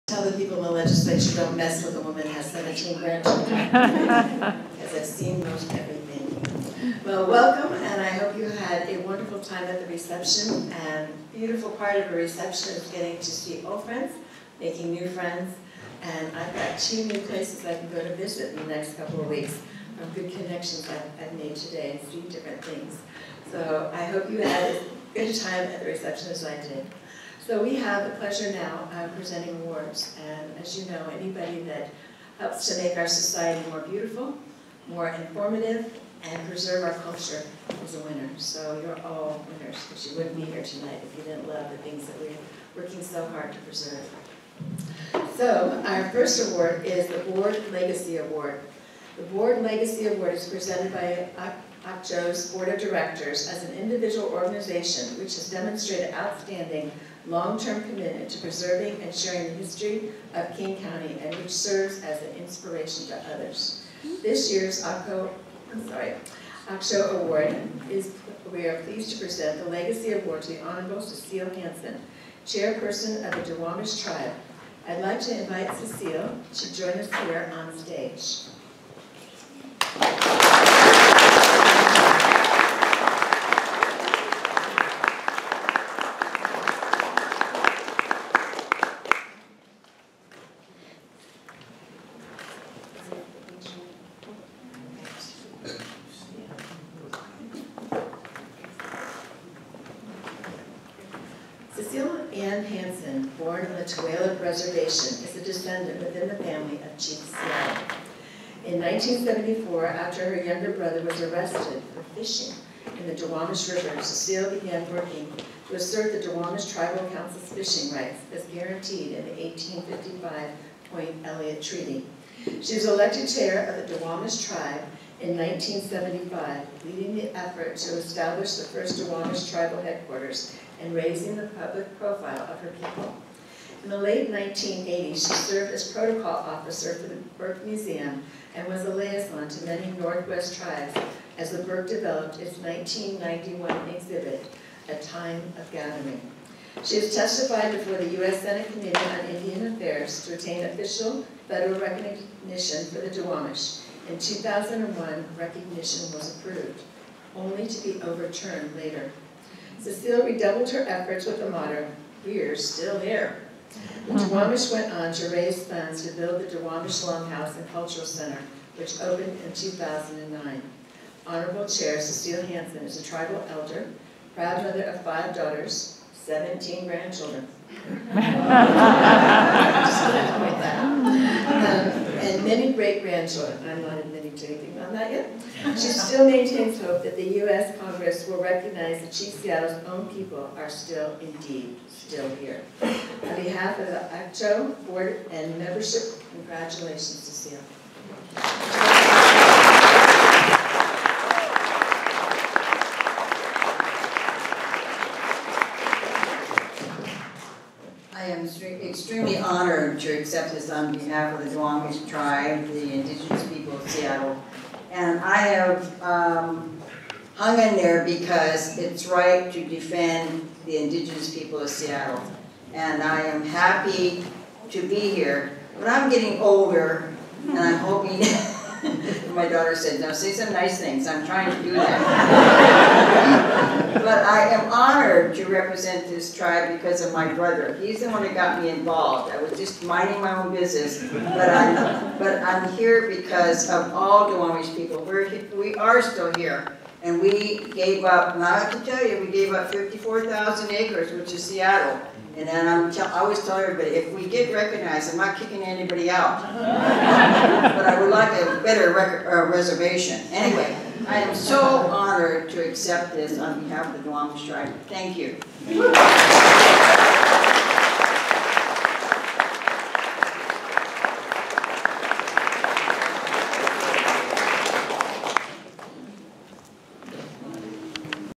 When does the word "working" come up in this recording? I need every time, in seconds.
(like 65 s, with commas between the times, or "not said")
42 s, 114 s.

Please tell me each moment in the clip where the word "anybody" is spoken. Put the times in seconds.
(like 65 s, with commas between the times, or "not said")
31 s, 255 s.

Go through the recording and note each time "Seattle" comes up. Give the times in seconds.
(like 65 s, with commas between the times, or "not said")
107 s, 189 s, 197 s, 213 s, 221 s, 251 s.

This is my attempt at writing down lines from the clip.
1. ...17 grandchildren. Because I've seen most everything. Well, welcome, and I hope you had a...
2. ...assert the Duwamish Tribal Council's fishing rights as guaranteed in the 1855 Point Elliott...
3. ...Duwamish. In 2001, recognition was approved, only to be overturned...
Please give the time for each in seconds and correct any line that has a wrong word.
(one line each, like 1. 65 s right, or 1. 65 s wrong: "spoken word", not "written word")
1. 2 s right
2. 115 s right
3. 153 s right.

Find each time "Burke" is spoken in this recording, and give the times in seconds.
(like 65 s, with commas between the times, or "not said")
137 s, 141 s.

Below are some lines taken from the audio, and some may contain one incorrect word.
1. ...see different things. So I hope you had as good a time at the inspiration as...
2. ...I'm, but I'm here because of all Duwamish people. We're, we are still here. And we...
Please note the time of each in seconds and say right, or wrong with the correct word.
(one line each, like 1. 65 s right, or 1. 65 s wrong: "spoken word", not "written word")
1. 22 s wrong: "reception", not "inspiration"
2. 241 s right.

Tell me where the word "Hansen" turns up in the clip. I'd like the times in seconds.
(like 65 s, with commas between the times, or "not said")
71 s, 102 s, 172 s.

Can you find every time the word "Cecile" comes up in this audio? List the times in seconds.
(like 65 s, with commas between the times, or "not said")
71 s, 75 s, 114 s, 159 s, 172 s.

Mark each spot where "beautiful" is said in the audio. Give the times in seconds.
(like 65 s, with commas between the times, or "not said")
11 s, 33 s.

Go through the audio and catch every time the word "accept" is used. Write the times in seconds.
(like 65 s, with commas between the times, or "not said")
210 s, 262 s.